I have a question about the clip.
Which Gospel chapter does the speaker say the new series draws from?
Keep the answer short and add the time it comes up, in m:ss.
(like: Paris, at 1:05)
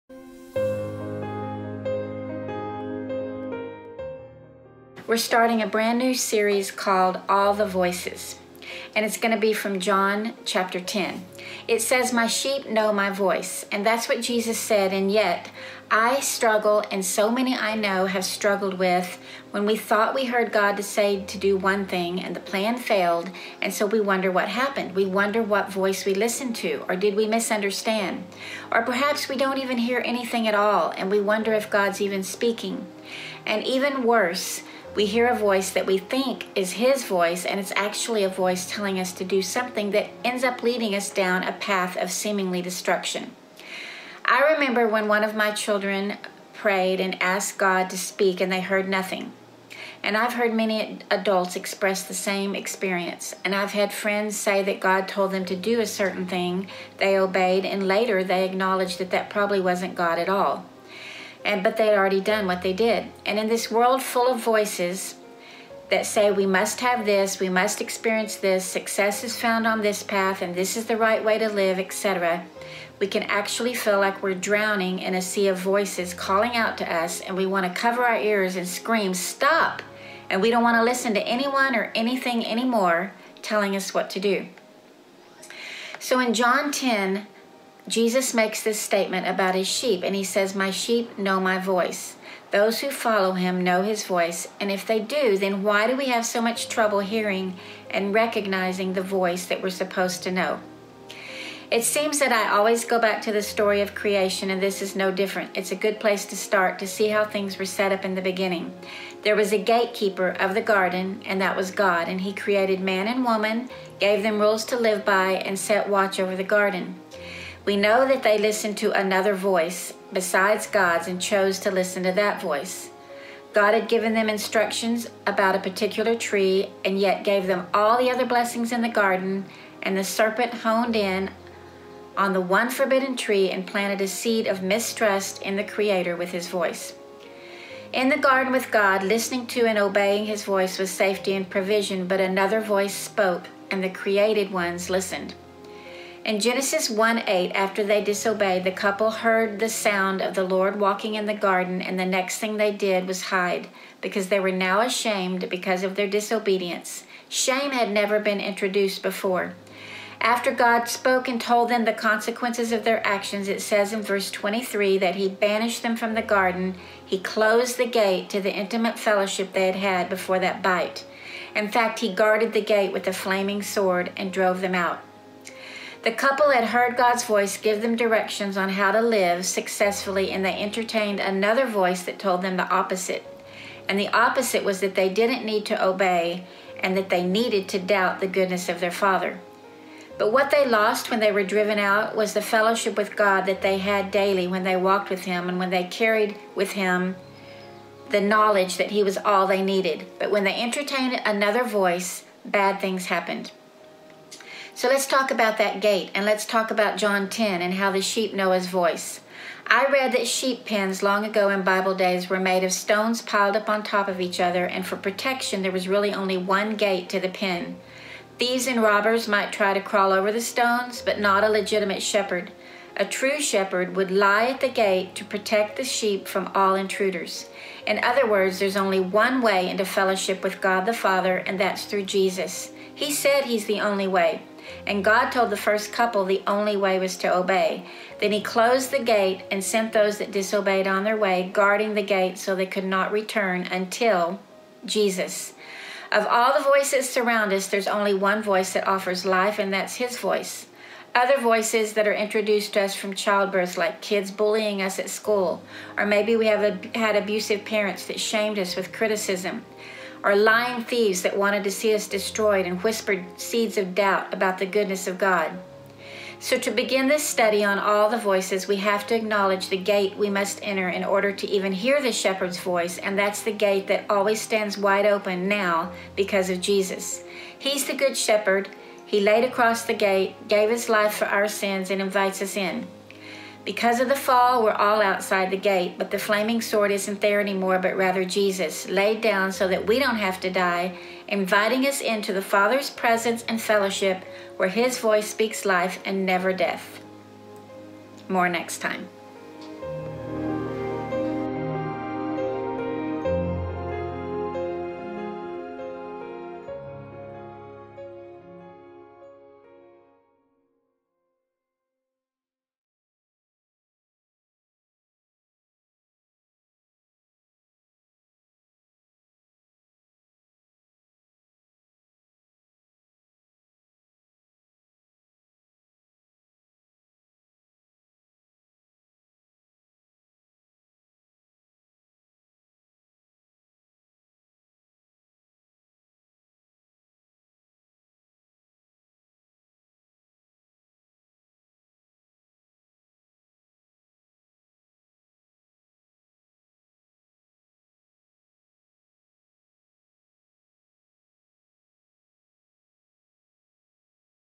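John chapter 10, at 0:09.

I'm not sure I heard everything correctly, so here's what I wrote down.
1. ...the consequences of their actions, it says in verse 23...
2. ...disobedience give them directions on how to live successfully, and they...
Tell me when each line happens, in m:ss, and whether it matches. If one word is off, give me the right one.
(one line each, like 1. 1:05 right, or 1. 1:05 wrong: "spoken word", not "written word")
1. 2:41 right
2. 2:57 wrong: "voice", not "disobedience".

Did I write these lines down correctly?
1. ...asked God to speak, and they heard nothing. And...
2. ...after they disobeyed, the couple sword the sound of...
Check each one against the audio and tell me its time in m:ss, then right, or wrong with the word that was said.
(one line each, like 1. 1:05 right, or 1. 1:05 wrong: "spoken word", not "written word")
1. 0:47 right
2. 2:27 wrong: "heard", not "sword".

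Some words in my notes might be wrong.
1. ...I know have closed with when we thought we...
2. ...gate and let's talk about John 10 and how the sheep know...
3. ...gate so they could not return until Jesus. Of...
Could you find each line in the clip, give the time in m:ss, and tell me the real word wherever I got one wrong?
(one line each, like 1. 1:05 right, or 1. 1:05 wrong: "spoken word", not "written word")
1. 0:17 wrong: "struggled", not "closed"
2. 3:25 right
3. 4:02 right.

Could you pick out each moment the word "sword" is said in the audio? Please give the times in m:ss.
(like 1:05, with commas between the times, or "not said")
2:53, 4:46.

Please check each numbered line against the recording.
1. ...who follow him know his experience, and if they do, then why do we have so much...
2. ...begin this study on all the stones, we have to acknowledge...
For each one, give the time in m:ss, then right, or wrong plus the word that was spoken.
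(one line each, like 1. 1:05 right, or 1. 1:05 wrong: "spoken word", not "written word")
1. 1:32 wrong: "voice", not "experience"
2. 4:26 wrong: "voices", not "stones".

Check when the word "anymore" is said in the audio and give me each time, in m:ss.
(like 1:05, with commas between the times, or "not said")
1:22, 4:47.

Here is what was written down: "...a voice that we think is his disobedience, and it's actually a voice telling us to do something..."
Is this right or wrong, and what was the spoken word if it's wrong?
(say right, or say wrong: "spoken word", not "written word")
wrong: "voice", not "disobedience".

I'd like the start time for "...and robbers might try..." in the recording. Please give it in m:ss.
3:38.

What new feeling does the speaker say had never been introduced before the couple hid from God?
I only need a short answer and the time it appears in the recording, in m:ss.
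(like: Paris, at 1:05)
Shame, at 2:37.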